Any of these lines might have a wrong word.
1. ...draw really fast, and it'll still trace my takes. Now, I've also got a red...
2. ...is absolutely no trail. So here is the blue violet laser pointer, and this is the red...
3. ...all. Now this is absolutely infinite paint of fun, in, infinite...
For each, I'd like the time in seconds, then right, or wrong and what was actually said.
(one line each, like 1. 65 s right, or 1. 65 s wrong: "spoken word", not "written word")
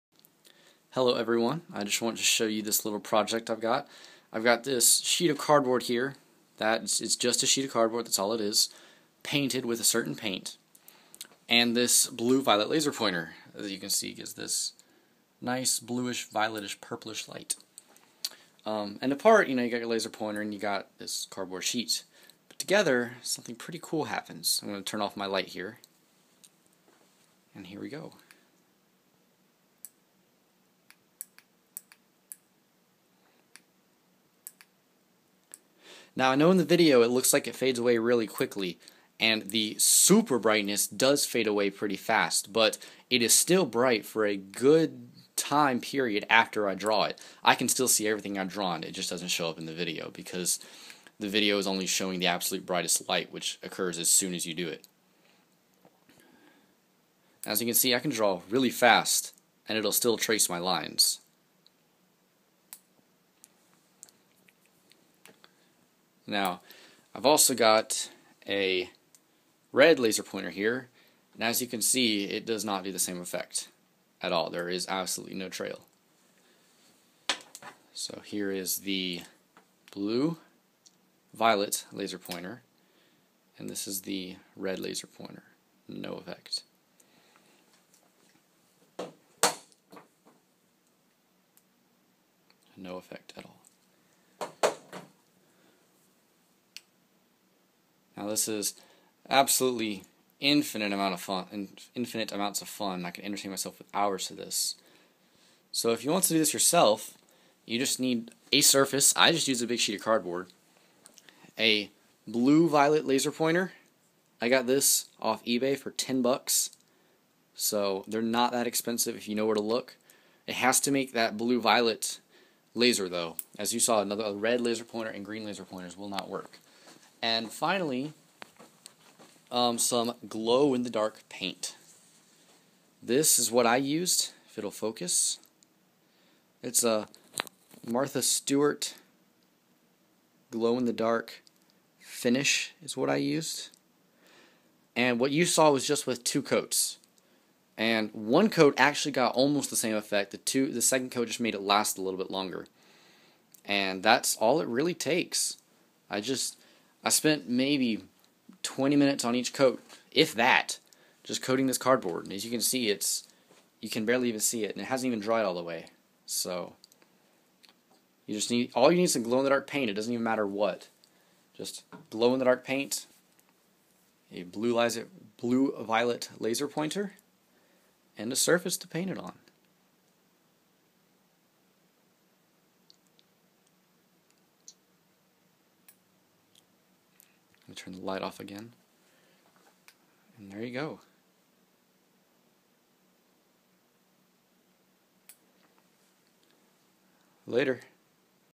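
1. 58 s wrong: "lines", not "takes"
2. 74 s right
3. 93 s wrong: "amount", not "paint".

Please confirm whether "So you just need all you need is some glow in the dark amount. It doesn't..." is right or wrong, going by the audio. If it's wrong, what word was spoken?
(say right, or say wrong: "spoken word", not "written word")
wrong: "paint", not "amount".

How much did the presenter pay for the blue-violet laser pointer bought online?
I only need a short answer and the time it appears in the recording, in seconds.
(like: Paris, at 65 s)
$10, at 115 s.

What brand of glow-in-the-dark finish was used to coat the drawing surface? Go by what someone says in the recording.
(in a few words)
Martha Stewart.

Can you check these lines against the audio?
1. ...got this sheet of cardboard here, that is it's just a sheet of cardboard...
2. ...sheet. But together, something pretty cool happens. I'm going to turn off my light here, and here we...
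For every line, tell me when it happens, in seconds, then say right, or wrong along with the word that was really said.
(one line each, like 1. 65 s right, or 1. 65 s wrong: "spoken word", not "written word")
1. 4 s right
2. 21 s right.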